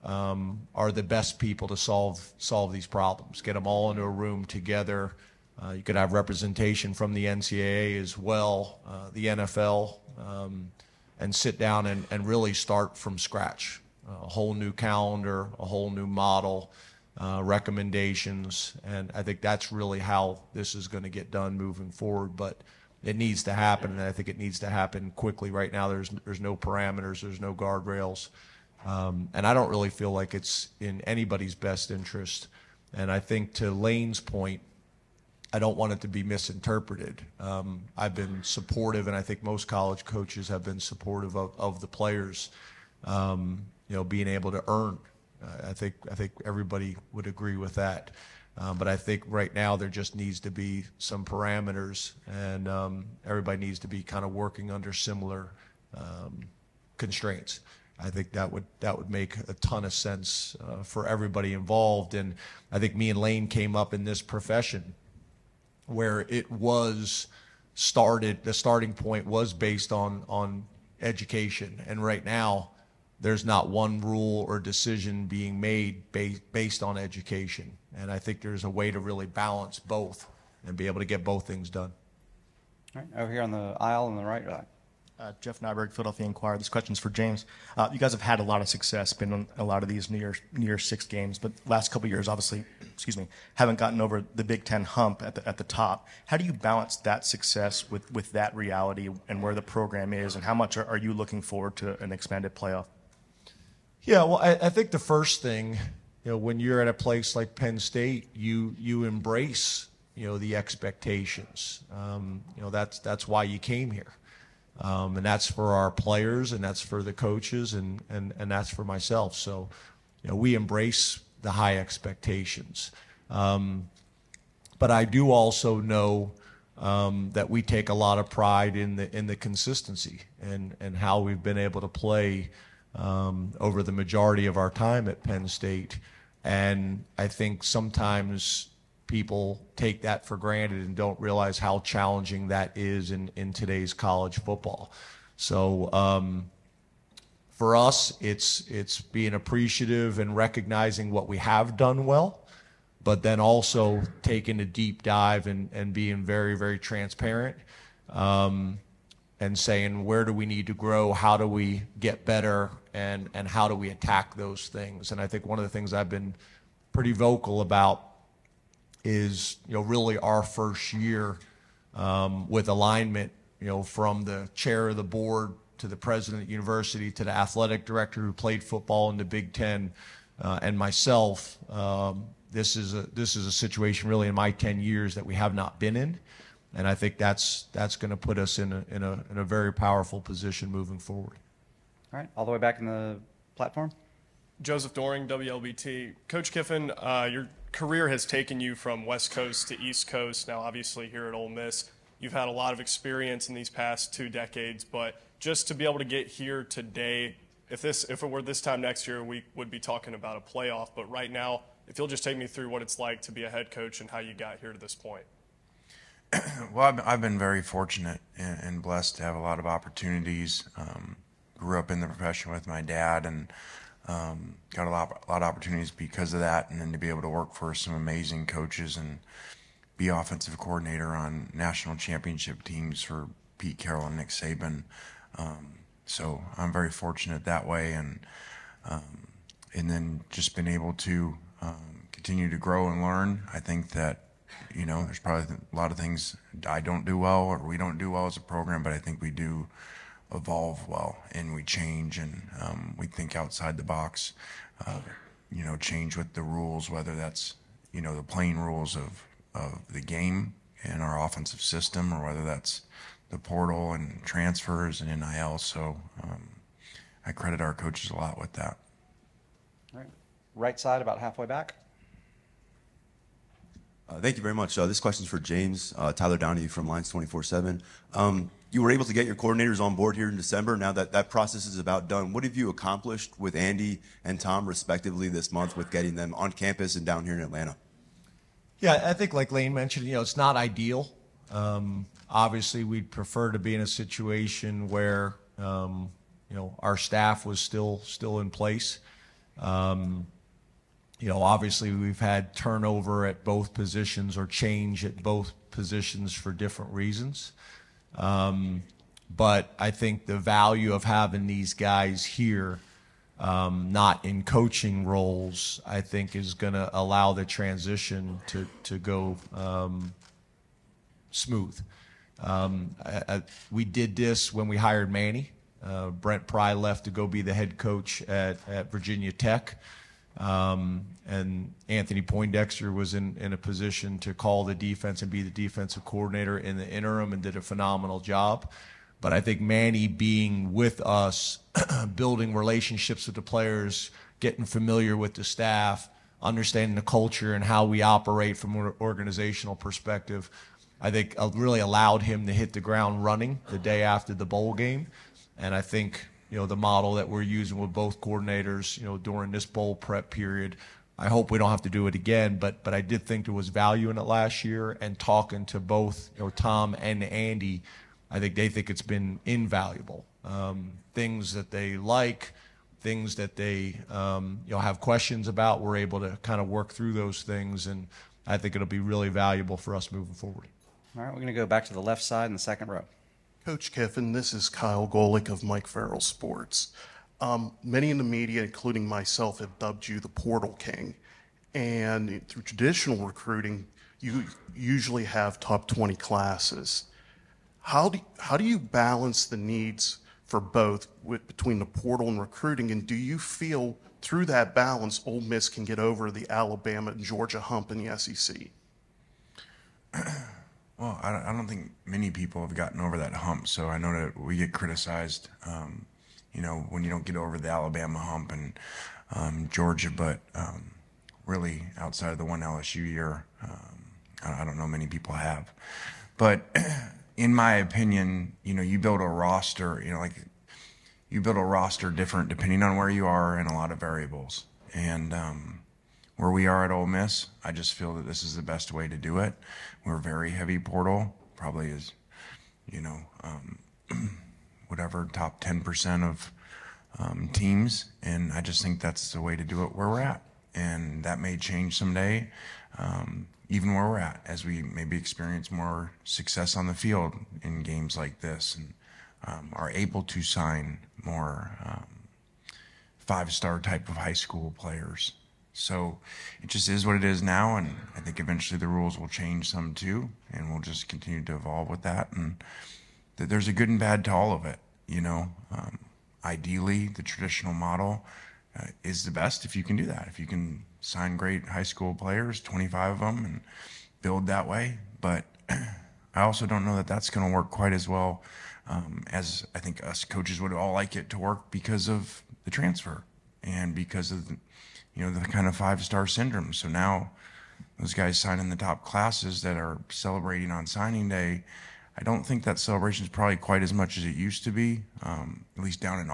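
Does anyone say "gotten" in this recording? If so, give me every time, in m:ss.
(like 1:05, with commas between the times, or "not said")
1:33, 6:52.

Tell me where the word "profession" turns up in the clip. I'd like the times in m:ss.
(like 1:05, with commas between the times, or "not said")
1:04, 3:42.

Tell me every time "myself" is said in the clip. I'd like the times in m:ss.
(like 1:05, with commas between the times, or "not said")
1:58, 3:00, 6:29.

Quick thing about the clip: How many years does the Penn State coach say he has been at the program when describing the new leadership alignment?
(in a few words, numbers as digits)
10.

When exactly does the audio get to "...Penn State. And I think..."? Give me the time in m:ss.
2:15.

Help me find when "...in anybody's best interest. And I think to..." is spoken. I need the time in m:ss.
0:30.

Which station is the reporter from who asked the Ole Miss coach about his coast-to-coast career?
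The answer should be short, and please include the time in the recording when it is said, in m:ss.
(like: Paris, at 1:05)
WLBT, at 3:15.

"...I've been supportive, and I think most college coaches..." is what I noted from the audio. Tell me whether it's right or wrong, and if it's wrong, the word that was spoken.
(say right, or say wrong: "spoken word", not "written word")
right.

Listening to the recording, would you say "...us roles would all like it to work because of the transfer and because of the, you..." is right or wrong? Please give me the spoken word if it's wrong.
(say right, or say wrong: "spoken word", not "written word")
wrong: "coaches", not "roles".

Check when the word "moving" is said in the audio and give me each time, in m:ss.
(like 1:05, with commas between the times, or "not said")
0:21, 3:10, 6:20.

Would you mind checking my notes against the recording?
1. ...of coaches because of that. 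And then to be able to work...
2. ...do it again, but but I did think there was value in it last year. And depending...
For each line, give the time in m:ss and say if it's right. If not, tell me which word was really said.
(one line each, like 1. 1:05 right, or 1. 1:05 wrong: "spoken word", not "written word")
1. 3:45 wrong: "opportunities", not "coaches"
2. 6:01 wrong: "talking", not "depending".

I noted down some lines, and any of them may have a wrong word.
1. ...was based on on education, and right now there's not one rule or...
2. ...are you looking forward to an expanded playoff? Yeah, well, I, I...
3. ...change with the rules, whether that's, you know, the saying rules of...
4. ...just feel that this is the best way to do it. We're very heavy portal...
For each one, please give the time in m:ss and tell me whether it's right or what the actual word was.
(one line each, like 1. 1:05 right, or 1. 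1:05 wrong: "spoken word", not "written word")
1. 1:09 right
2. 1:40 right
3. 4:15 wrong: "playing", not "saying"
4. 7:17 right.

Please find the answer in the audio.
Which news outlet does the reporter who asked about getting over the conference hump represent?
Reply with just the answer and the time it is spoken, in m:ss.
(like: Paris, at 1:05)
Philadelphia Inquirer, at 1:25.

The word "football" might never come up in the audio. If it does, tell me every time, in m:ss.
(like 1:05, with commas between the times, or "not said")
2:24, 2:58.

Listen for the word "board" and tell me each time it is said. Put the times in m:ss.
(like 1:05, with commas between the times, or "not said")
2:55, 4:39.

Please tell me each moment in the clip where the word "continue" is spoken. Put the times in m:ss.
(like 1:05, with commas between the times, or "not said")
4:02, 7:51.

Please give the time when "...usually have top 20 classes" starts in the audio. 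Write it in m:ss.
6:34.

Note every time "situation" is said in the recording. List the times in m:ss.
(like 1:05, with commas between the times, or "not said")
3:03, 4:53.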